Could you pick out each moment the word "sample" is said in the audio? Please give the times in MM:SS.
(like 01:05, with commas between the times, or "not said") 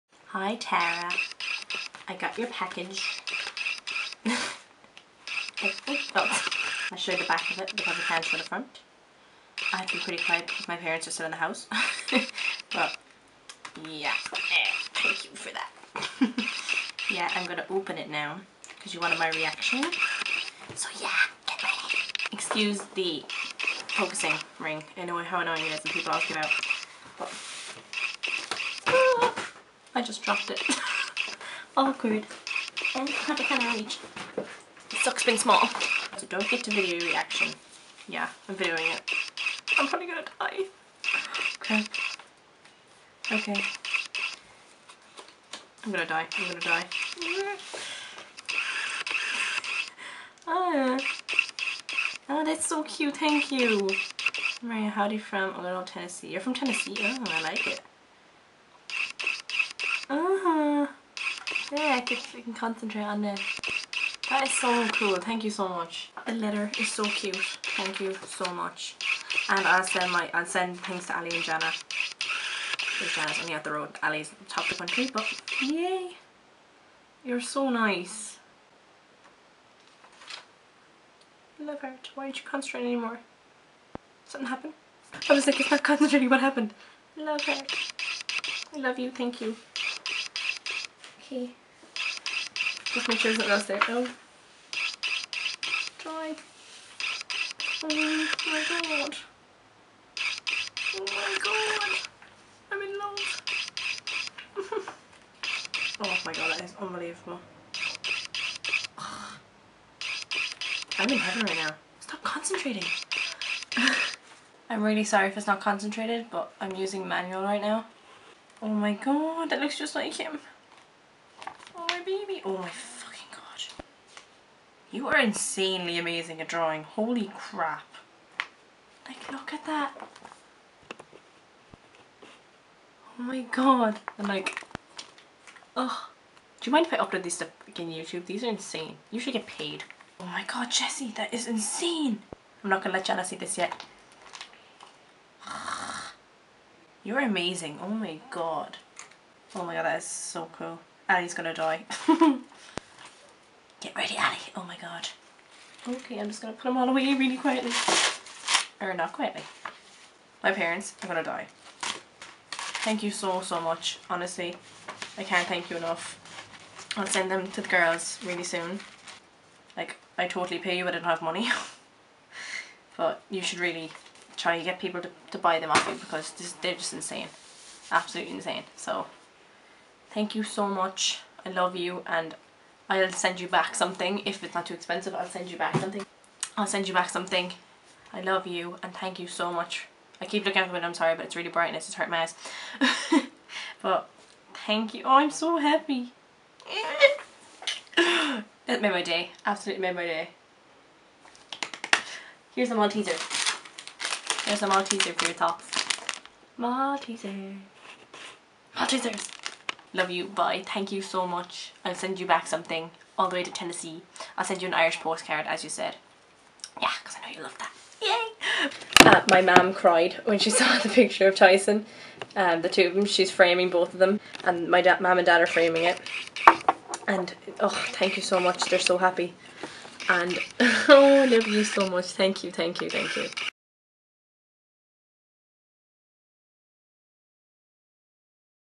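not said.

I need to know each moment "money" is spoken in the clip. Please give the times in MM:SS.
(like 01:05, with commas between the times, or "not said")
02:51.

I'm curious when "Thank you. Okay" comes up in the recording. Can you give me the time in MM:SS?
01:29.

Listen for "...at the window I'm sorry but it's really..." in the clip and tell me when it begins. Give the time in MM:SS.
03:10.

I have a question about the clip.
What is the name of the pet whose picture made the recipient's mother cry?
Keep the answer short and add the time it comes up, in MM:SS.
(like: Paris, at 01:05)
Tyson, at 03:41.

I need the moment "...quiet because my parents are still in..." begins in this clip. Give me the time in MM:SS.
00:10.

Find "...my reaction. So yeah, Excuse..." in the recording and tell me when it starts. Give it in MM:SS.
00:19.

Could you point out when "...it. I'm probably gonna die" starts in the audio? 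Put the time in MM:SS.
00:38.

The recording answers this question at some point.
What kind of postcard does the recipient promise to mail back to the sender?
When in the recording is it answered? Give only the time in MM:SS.
03:34.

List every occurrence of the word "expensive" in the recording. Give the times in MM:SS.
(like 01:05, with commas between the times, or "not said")
03:04.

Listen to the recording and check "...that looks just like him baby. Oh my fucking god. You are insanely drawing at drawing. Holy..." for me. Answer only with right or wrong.
wrong.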